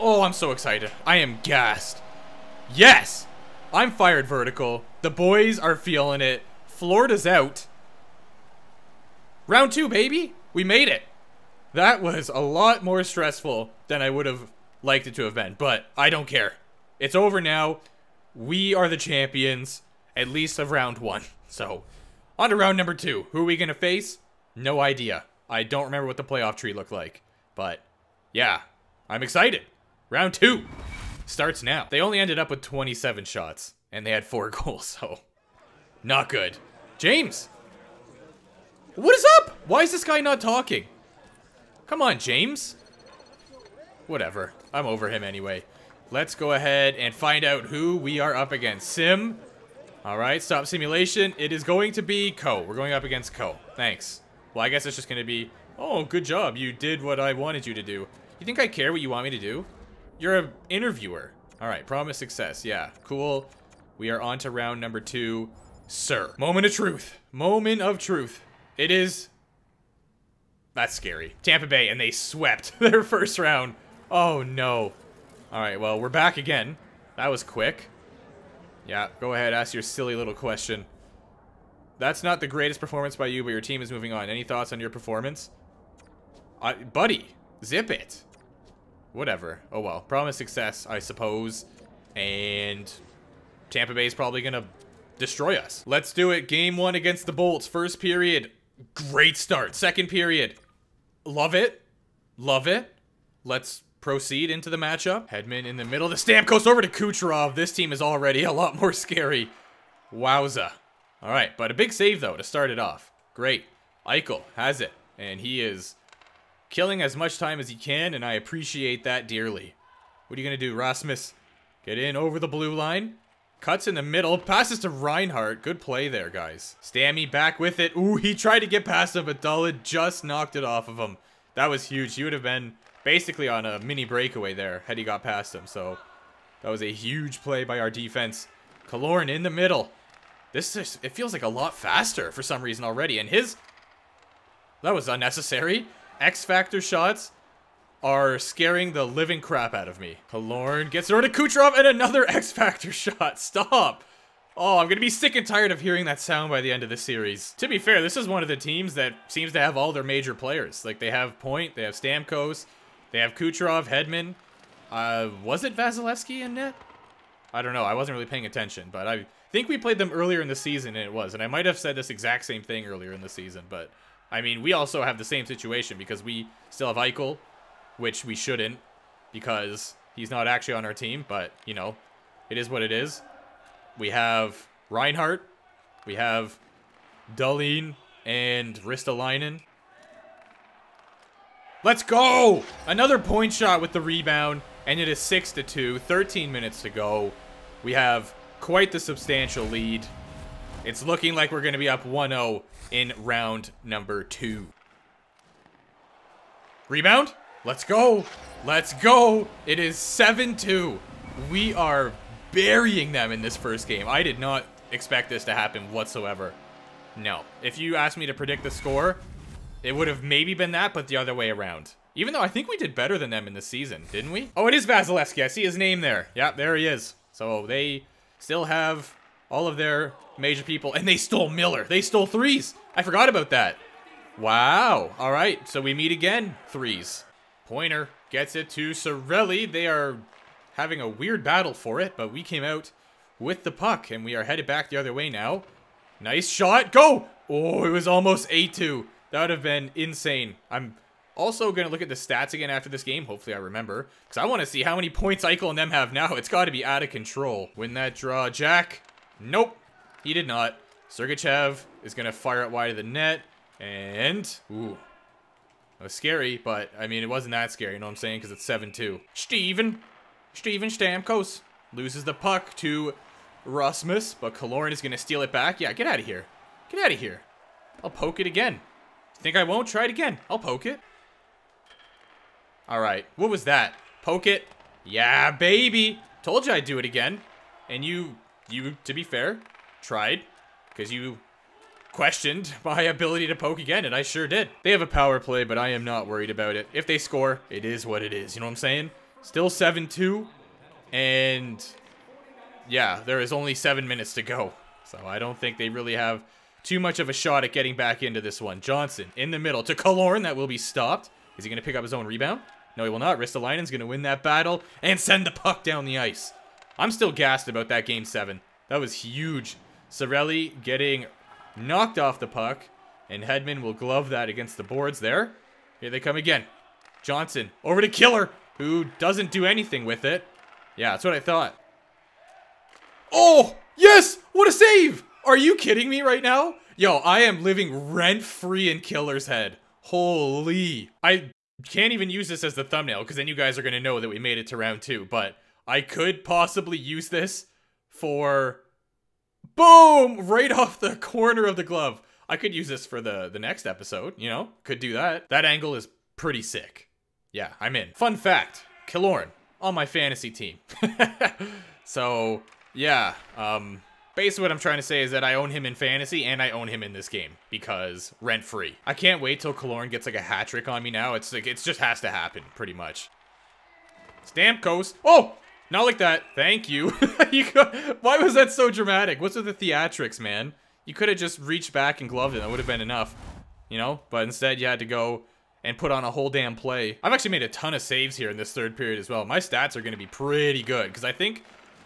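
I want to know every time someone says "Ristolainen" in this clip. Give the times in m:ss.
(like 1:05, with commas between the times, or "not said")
3:08, 5:13.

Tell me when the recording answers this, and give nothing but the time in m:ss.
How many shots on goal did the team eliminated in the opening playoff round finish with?
0:32.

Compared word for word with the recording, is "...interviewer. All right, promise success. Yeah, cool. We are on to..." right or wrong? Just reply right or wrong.
right.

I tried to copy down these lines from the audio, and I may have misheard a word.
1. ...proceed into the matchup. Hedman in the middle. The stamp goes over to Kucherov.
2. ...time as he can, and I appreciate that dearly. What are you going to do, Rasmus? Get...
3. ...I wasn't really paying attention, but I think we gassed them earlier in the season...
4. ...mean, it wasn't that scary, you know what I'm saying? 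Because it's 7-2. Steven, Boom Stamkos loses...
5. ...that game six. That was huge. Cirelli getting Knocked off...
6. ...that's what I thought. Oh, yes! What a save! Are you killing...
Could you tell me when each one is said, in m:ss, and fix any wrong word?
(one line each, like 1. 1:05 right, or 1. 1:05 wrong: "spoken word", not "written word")
1. 1:43 right
2. 1:57 right
3. 2:47 wrong: "played", not "gassed"
4. 4:27 wrong: "Steven", not "Boom"
5. 5:17 wrong: "seven", not "six"
6. 5:31 wrong: "kidding", not "killing".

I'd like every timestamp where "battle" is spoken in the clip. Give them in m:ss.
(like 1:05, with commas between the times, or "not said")
4:01, 5:14.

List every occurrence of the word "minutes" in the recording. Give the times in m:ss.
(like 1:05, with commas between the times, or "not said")
3:16, 5:04.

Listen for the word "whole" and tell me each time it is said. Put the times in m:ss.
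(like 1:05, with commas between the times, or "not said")
6:26.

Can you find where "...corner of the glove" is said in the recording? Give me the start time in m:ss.
5:51.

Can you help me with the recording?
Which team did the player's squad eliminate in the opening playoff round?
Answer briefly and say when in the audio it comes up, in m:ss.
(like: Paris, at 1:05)
Florida, at 0:06.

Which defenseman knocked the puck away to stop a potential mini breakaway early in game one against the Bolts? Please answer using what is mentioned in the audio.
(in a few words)
Dullard.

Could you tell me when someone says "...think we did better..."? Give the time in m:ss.
3:42.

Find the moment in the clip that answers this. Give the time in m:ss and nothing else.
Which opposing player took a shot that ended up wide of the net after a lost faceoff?
4:21.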